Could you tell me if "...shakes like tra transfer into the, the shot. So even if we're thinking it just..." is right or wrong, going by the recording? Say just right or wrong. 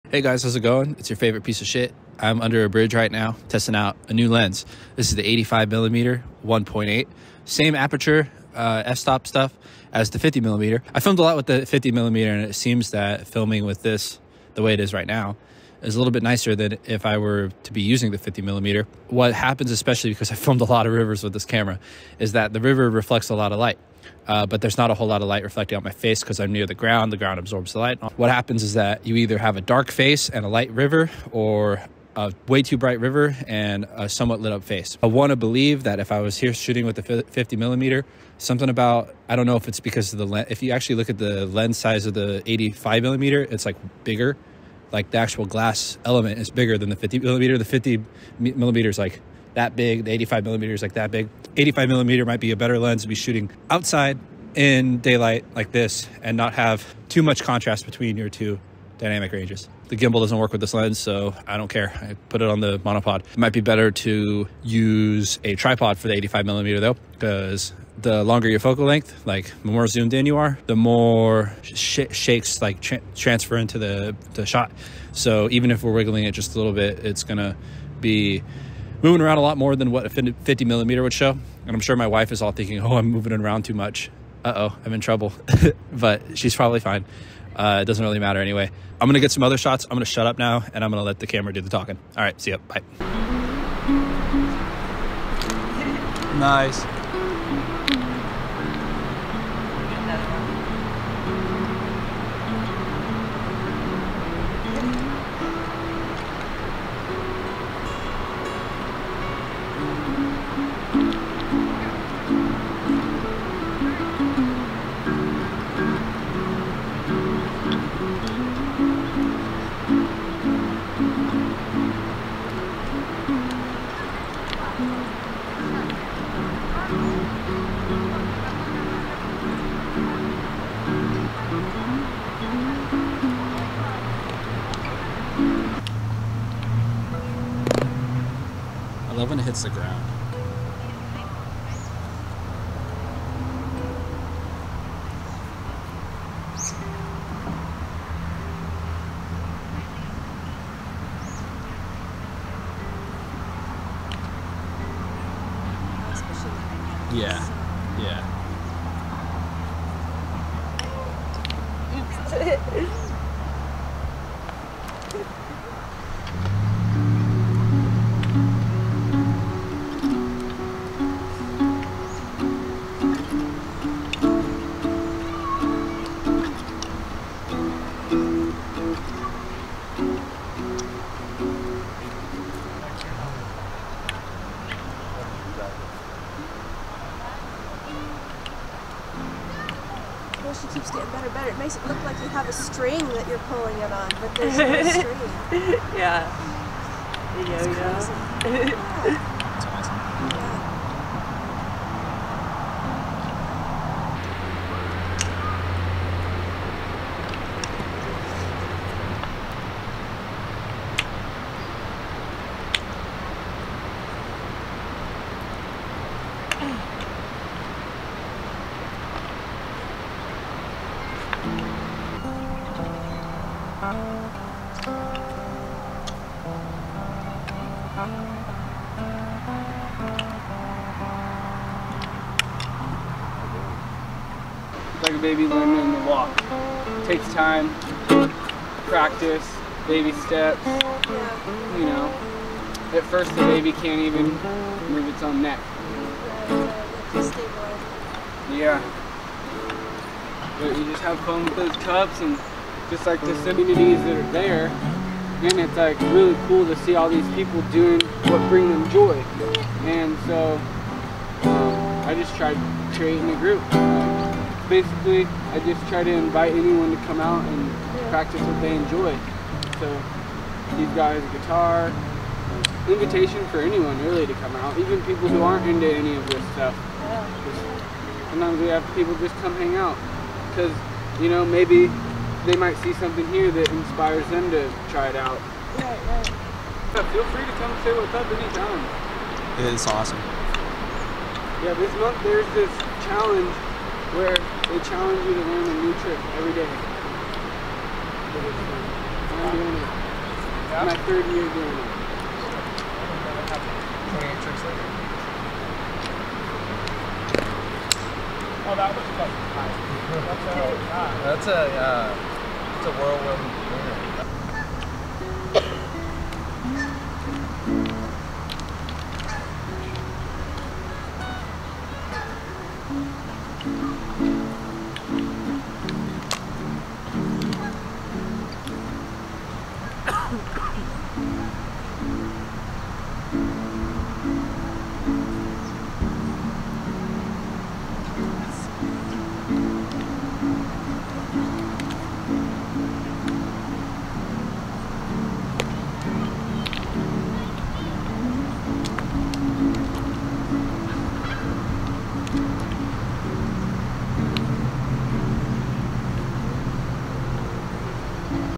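wrong.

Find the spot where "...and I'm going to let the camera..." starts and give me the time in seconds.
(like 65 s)
90 s.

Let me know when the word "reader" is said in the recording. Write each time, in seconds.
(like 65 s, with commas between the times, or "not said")
not said.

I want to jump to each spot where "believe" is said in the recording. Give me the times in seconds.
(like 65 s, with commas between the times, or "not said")
35 s.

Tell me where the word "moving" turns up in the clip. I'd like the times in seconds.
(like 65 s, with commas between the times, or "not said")
79 s, 83 s.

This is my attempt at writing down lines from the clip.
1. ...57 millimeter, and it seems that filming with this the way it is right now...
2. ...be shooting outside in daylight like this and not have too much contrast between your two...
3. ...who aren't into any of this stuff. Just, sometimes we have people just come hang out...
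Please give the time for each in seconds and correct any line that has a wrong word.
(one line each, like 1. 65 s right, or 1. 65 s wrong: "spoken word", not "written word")
1. 11 s wrong: "50", not "57"
2. 53 s right
3. 275 s right.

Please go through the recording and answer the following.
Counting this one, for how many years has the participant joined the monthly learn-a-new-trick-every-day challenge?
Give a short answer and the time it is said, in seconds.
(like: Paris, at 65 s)
3, at 301 s.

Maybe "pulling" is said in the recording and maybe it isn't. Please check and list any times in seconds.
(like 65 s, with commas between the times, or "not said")
193 s.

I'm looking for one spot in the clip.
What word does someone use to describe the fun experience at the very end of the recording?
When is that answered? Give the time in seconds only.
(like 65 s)
312 s.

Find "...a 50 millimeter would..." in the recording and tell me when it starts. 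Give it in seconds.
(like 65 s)
80 s.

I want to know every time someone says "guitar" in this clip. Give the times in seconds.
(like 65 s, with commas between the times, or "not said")
271 s.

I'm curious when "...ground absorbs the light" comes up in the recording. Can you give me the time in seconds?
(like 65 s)
27 s.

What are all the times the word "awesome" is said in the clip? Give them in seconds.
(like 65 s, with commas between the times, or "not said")
199 s, 289 s.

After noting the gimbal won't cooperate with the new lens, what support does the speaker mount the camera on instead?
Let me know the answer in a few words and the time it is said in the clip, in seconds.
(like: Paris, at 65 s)
monopod, at 62 s.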